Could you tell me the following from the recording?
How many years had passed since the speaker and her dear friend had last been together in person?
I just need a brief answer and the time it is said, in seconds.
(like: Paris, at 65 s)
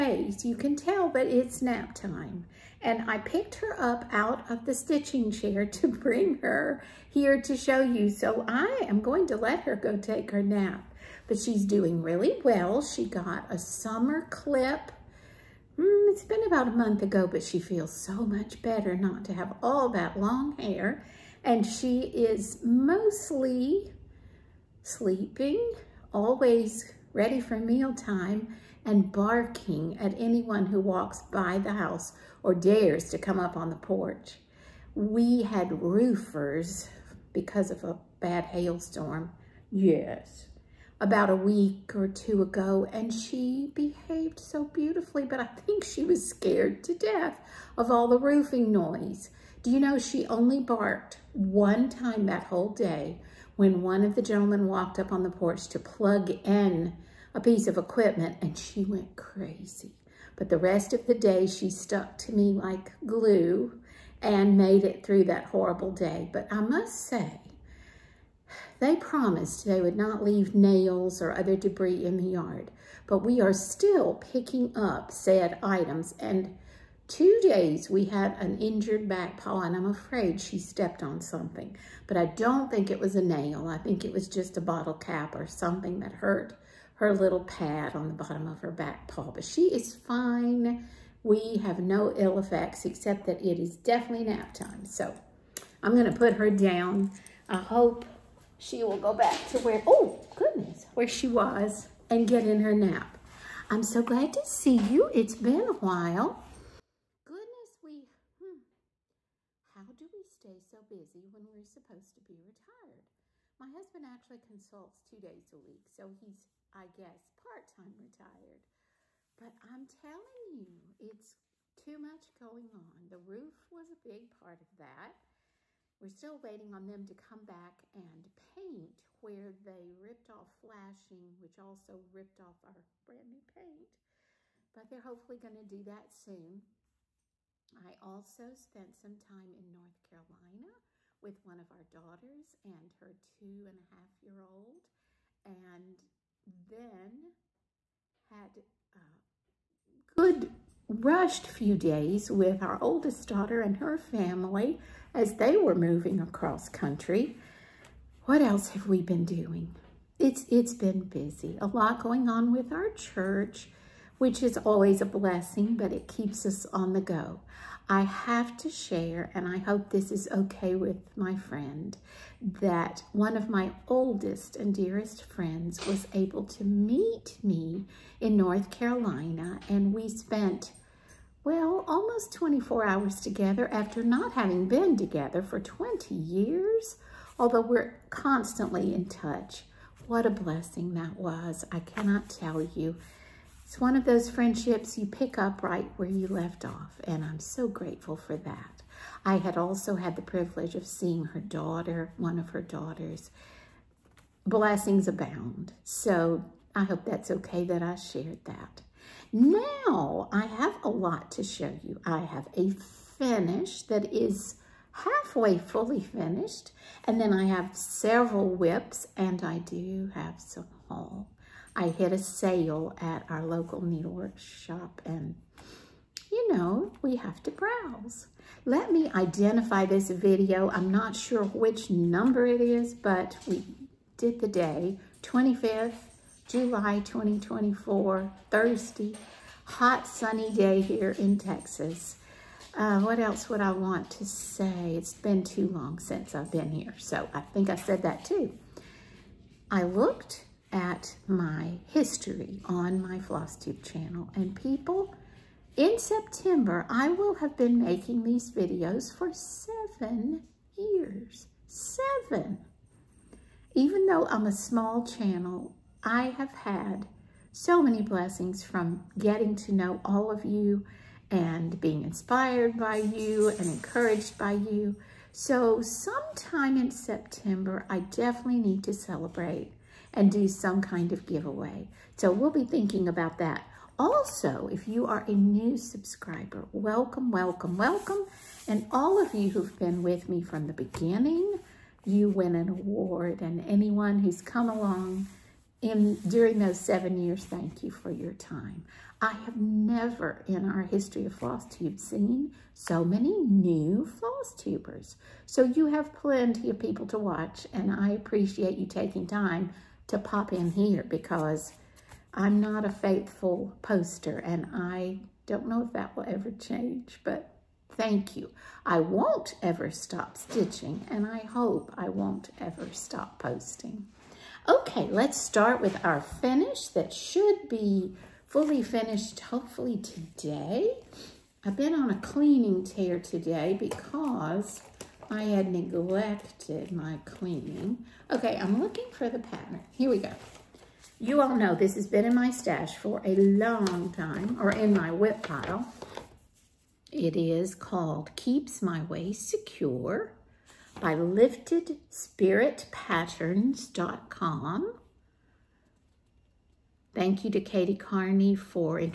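20, at 185 s.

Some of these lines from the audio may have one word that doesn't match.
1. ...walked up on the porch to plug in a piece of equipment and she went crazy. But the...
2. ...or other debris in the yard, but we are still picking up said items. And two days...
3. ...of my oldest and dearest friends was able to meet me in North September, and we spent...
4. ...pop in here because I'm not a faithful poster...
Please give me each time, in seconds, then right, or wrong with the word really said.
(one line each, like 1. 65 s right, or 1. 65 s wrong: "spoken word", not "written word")
1. 54 s right
2. 71 s right
3. 173 s wrong: "Carolina", not "September"
4. 310 s right.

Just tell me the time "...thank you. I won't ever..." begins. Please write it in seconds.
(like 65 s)
317 s.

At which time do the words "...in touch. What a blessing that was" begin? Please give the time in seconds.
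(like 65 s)
188 s.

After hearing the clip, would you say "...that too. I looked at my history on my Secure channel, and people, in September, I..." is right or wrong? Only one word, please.
wrong.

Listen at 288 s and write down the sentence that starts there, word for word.
And all of you who've been with me from the beginning, you win an award.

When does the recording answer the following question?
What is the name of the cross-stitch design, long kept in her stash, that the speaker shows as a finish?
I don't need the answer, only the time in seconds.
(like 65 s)
348 s.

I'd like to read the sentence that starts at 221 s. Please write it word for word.
I hit a sale at our local needlework shop and you know, we have to browse.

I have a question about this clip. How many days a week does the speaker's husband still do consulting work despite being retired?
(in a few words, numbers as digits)
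2.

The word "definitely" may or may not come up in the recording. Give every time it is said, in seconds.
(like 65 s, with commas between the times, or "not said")
93 s, 277 s.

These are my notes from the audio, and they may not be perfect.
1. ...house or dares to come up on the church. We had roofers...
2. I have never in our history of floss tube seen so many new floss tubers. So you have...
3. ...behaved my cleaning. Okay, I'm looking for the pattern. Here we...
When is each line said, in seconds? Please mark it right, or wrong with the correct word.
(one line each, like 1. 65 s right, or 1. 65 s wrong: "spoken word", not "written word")
1. 31 s wrong: "porch", not "church"
2. 299 s right
3. 335 s wrong: "neglected", not "behaved".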